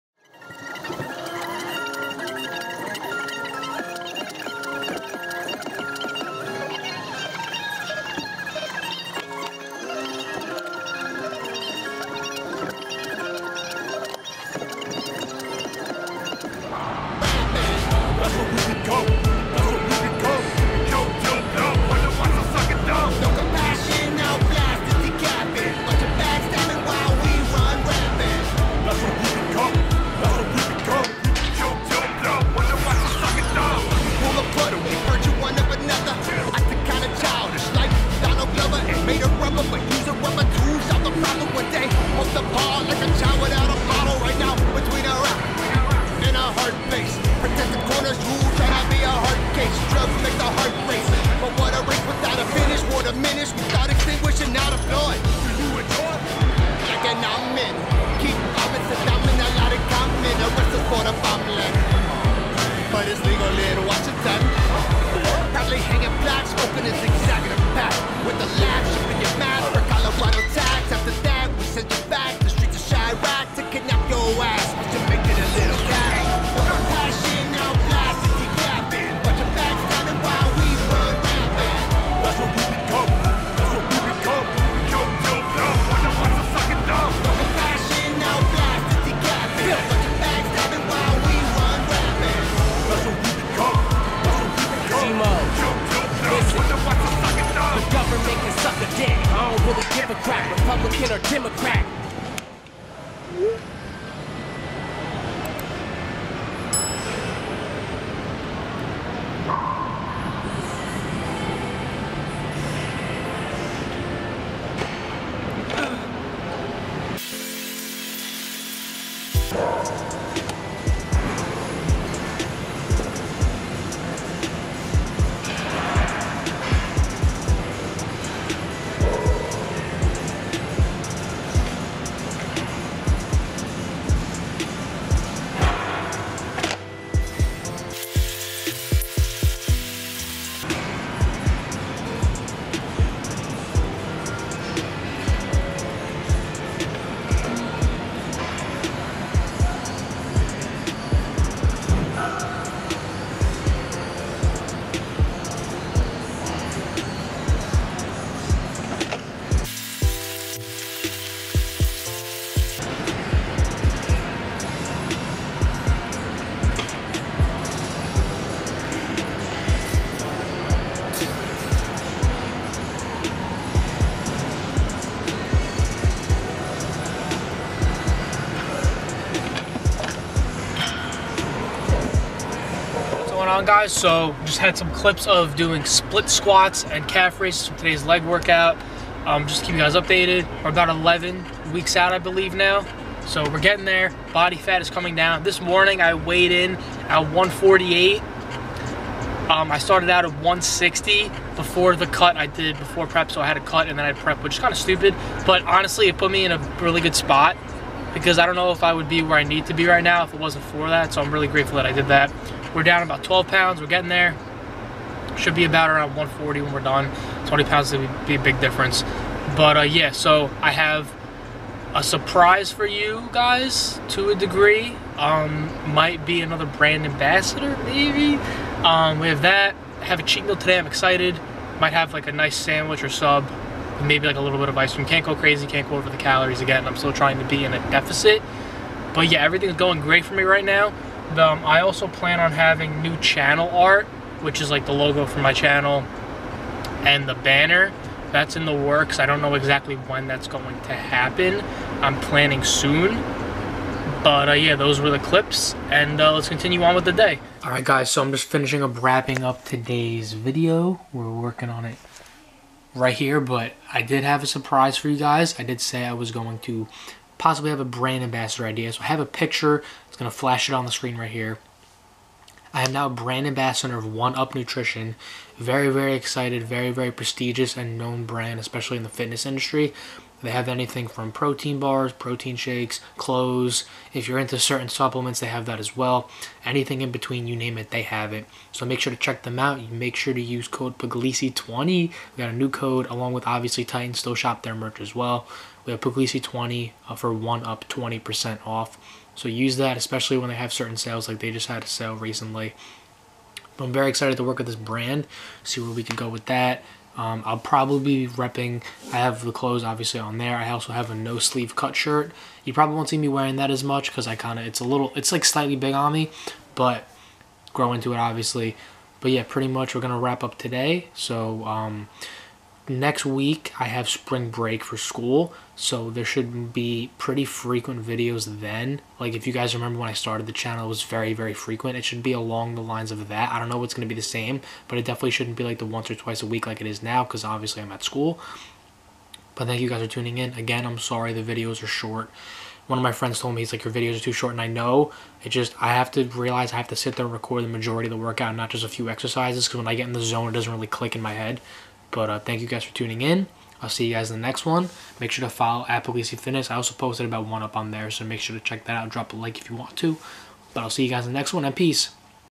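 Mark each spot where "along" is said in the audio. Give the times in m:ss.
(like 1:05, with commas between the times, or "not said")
4:53, 5:32.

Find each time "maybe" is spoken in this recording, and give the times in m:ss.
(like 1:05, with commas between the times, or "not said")
3:47, 3:54.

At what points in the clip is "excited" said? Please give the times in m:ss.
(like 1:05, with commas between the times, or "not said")
3:50, 4:36, 5:04.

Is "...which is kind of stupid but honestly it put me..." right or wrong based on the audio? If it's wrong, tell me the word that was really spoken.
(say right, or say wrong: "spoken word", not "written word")
right.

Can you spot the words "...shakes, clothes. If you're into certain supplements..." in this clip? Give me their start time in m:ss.
4:42.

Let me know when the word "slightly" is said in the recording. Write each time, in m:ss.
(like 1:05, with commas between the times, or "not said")
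5:15.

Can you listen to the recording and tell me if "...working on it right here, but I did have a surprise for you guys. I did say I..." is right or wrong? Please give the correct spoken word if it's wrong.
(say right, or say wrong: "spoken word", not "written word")
right.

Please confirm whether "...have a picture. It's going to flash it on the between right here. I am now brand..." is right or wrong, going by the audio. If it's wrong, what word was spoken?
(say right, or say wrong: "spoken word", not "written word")
wrong: "screen", not "between".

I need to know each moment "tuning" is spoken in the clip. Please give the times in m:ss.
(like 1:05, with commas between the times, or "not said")
5:40, 5:52.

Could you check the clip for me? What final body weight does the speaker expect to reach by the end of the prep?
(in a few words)
140.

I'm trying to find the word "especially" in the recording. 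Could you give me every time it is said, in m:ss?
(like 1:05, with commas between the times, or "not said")
4:38, 4:59.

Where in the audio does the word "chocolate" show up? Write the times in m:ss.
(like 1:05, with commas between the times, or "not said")
not said.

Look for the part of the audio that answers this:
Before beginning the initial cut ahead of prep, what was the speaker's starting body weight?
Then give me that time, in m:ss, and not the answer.
3:20.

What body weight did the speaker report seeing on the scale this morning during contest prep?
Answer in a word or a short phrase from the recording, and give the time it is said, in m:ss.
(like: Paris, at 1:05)
148, at 3:17.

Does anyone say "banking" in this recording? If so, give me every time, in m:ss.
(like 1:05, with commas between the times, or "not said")
not said.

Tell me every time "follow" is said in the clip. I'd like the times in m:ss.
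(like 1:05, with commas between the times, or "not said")
5:55.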